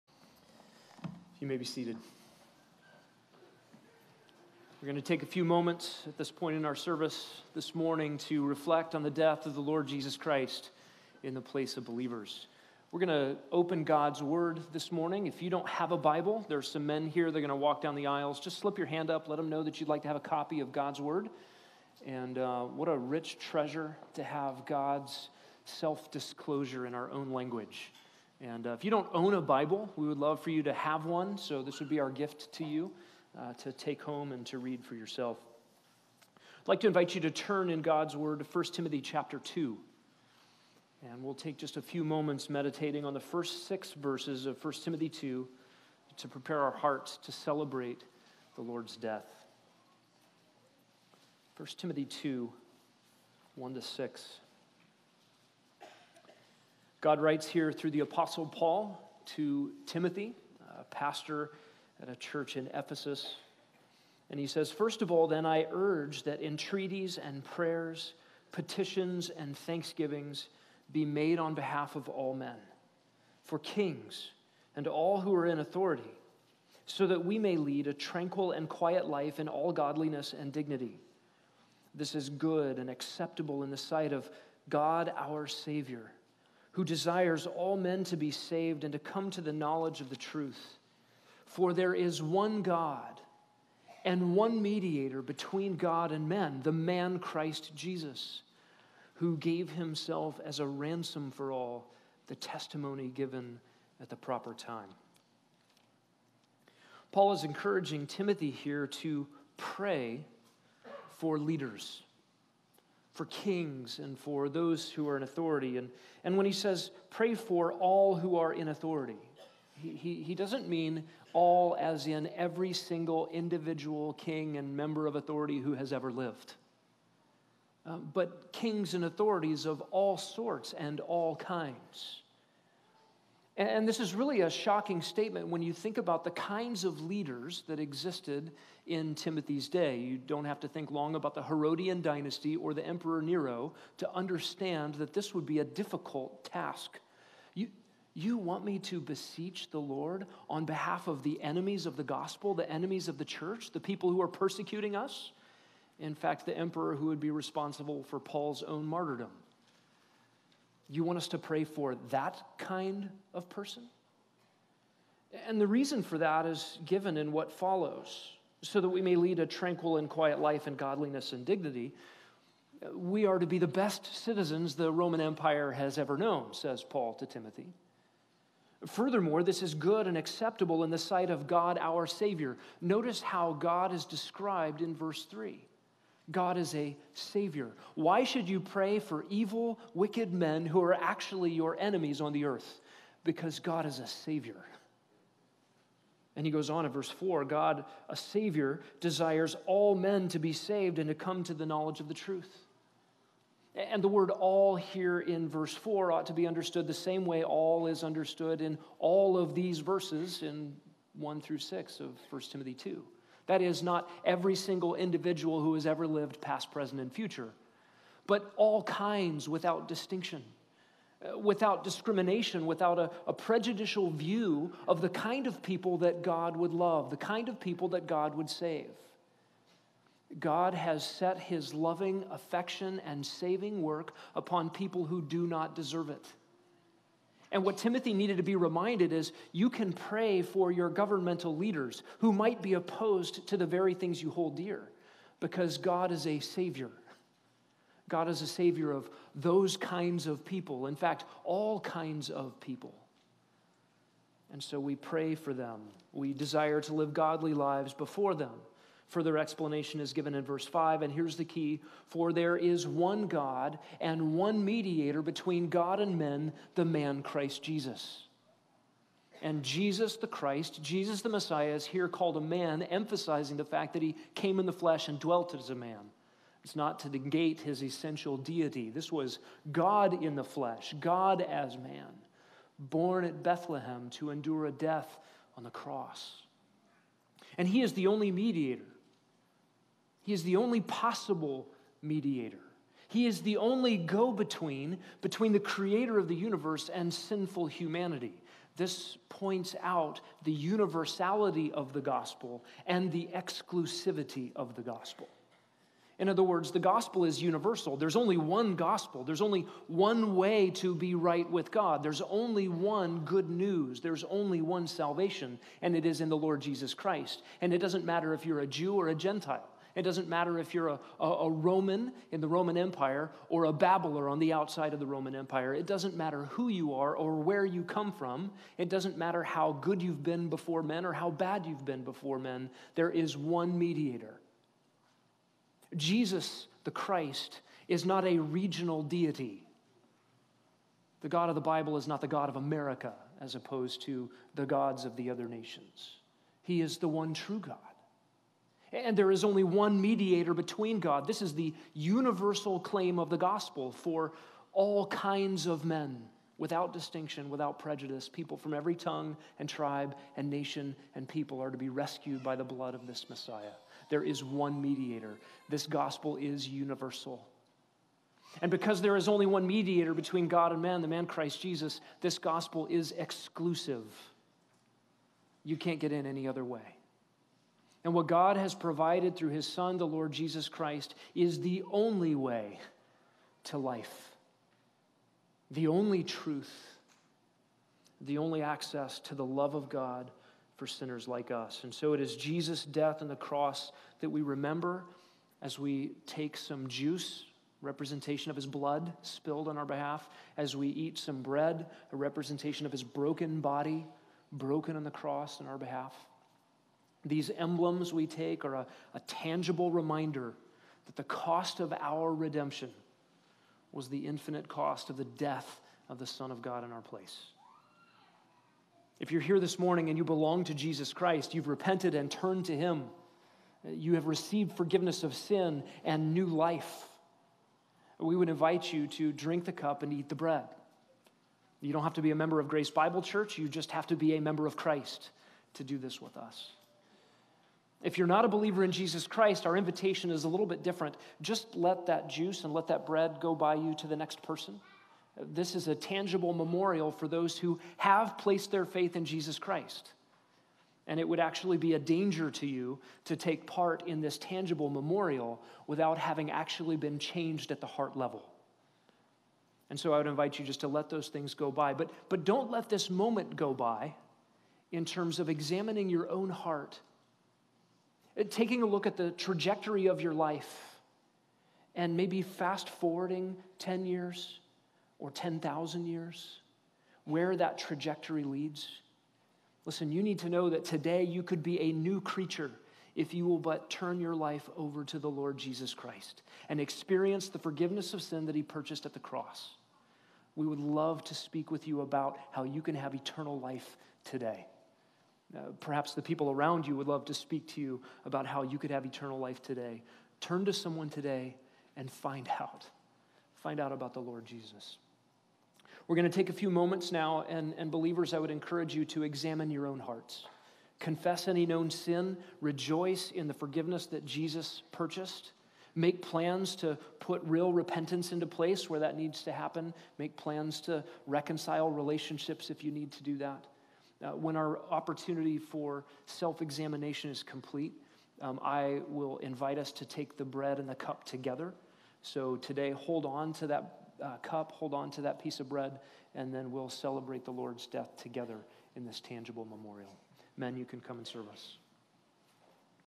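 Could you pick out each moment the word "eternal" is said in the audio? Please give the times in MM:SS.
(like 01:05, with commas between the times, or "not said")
08:13, 08:19.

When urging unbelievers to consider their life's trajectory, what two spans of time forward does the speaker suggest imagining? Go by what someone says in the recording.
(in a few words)
10 years or 10,000 years.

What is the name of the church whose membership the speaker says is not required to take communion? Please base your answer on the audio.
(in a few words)
Grace Bible Church.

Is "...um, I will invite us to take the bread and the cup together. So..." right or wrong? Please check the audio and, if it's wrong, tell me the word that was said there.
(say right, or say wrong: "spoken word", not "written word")
right.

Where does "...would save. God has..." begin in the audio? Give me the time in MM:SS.
03:48.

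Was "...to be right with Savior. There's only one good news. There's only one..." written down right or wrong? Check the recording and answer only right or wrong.
wrong.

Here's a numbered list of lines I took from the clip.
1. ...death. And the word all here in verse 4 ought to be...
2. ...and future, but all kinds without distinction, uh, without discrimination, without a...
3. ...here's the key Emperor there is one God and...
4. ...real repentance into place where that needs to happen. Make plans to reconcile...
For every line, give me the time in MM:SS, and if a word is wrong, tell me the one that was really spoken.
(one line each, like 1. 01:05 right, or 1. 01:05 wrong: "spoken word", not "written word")
1. 03:22 wrong: "truth", not "death"
2. 03:37 right
3. 04:21 wrong: "For", not "Emperor"
4. 08:37 right.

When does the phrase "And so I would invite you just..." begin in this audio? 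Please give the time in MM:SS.
07:39.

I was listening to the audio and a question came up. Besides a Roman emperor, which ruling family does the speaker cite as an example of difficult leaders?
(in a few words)
Herodian dynasty.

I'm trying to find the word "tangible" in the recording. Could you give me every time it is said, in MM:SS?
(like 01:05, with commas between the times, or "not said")
06:49, 07:25, 07:34, 08:59.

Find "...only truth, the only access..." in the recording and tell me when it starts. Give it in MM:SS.
06:25.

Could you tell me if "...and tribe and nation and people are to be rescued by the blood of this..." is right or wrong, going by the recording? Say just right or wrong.
right.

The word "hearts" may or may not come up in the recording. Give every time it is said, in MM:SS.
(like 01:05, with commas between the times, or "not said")
00:46, 07:37, 07:46, 08:29.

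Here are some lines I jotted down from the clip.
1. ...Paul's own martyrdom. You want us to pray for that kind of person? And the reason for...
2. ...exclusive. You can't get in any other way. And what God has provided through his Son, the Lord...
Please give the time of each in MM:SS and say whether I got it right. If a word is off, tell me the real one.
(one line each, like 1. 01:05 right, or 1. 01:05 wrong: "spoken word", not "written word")
1. 02:38 right
2. 06:13 right.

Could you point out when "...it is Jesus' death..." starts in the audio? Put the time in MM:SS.
06:32.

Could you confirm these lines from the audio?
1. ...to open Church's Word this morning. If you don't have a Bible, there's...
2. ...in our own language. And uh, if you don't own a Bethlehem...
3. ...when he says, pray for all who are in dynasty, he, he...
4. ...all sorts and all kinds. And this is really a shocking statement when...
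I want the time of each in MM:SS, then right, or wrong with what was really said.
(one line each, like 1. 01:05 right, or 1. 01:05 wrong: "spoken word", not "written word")
1. 00:13 wrong: "God", not "Church"
2. 00:26 wrong: "Bible", not "Bethlehem"
3. 01:56 wrong: "authority", not "dynasty"
4. 02:09 right.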